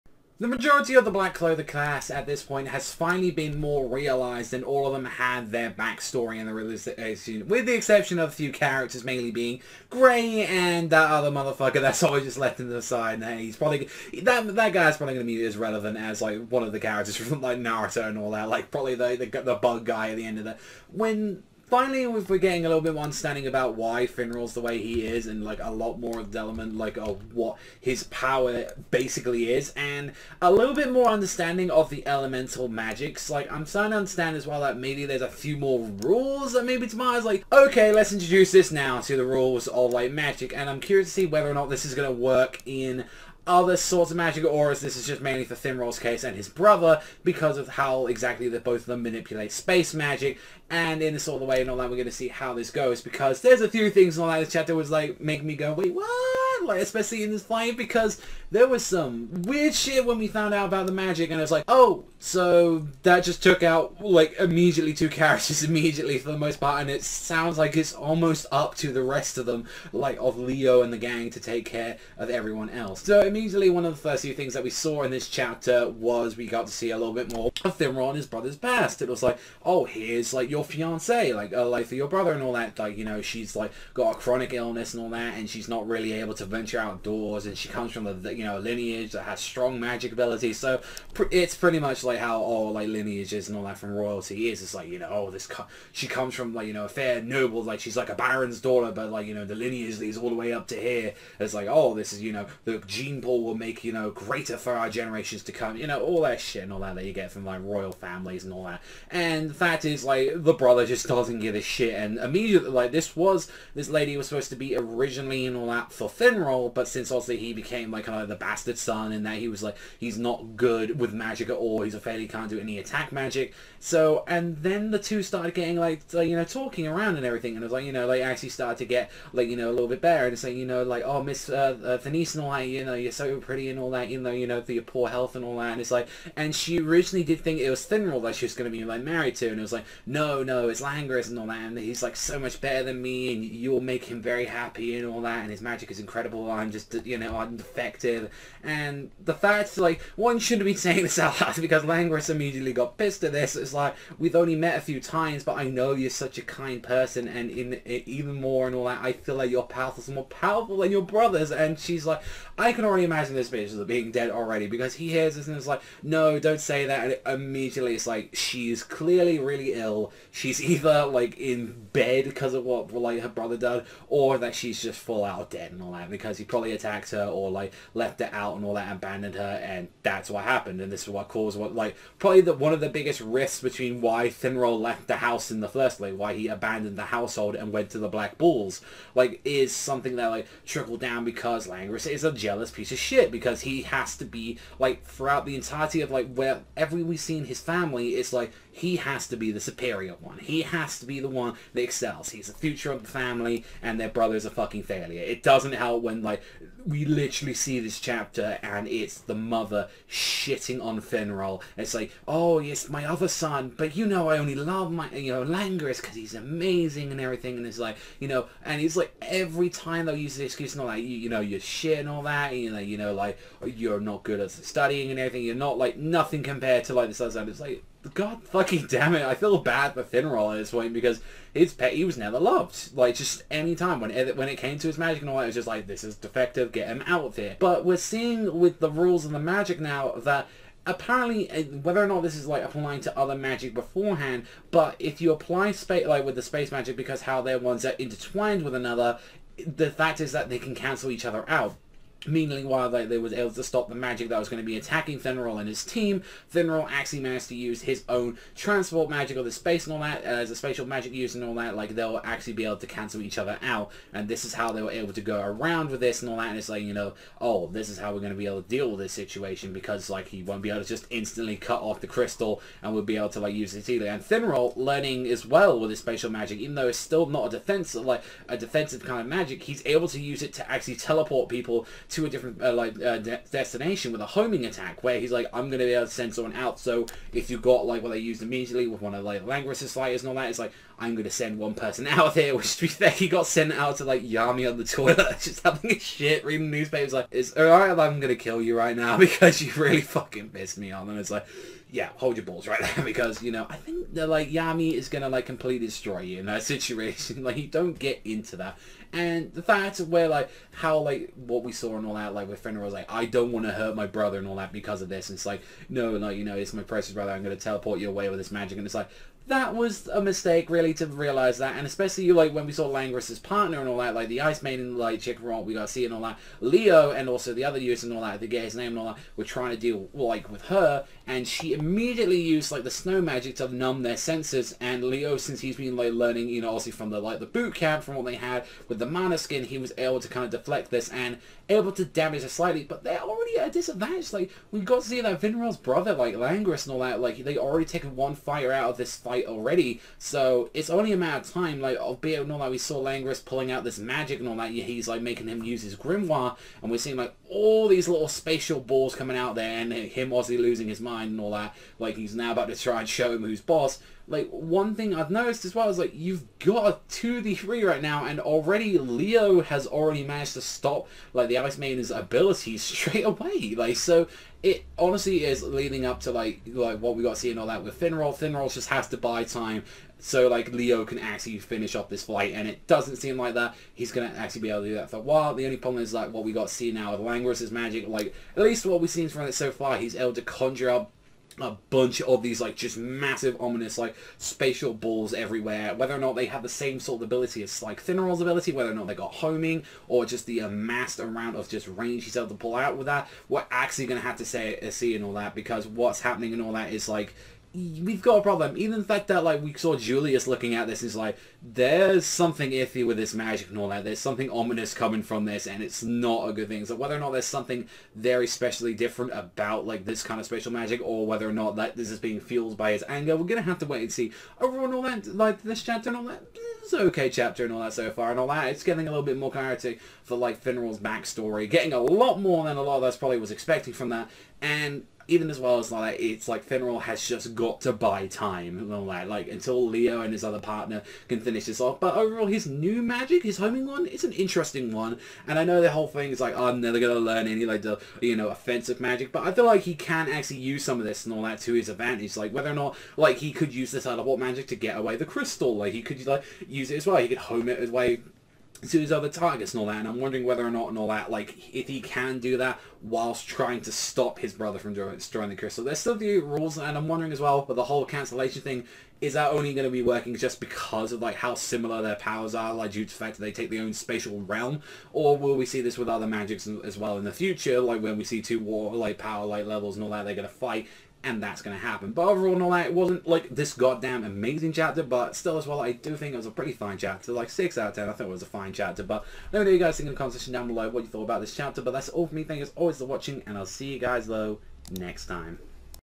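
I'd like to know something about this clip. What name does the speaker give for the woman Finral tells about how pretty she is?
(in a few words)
Denise.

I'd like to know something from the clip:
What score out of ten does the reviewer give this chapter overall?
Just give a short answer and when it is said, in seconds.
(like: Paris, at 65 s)
6, at 487 s.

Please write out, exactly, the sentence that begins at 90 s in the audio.
So pr it's pretty much like how all oh, like lineages and all that from royalty is.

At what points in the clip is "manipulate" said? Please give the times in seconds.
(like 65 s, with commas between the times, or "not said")
49 s.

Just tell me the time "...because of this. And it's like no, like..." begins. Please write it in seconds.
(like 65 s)
314 s.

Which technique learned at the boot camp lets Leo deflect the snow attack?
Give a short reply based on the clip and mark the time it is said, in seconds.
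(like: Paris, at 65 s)
Mana skin, at 339 s.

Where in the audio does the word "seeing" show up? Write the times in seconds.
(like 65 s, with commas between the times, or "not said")
237 s, 356 s.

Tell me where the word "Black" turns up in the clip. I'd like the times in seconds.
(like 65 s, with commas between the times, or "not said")
1 s, 188 s.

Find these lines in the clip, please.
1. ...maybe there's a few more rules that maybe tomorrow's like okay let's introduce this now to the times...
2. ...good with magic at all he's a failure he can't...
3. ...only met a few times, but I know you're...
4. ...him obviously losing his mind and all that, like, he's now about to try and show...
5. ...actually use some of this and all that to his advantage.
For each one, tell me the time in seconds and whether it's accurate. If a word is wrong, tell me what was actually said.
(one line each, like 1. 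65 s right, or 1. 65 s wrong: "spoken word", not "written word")
1. 34 s wrong: "rules", not "times"
2. 120 s right
3. 154 s right
4. 359 s right
5. 450 s right.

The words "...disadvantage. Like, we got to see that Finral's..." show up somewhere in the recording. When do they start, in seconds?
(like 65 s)
343 s.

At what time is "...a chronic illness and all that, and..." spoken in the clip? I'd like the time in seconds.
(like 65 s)
84 s.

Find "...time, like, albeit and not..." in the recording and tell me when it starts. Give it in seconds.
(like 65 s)
351 s.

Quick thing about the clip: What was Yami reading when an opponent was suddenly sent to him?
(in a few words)
Newspapers.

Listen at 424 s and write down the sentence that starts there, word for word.
Overall, and all that, like this chapter and all that, it's okay chapter and all that so far, and all that.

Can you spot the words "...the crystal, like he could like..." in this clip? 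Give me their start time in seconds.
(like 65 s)
455 s.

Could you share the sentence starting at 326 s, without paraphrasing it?
Leo and also the other users and all that, the guy's name and all that, were trying to deal, like, with her.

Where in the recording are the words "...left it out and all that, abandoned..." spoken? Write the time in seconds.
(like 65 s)
178 s.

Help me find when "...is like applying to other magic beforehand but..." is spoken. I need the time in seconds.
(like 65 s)
242 s.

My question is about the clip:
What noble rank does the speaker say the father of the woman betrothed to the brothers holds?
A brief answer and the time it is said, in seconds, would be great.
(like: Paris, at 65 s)
Baron, at 98 s.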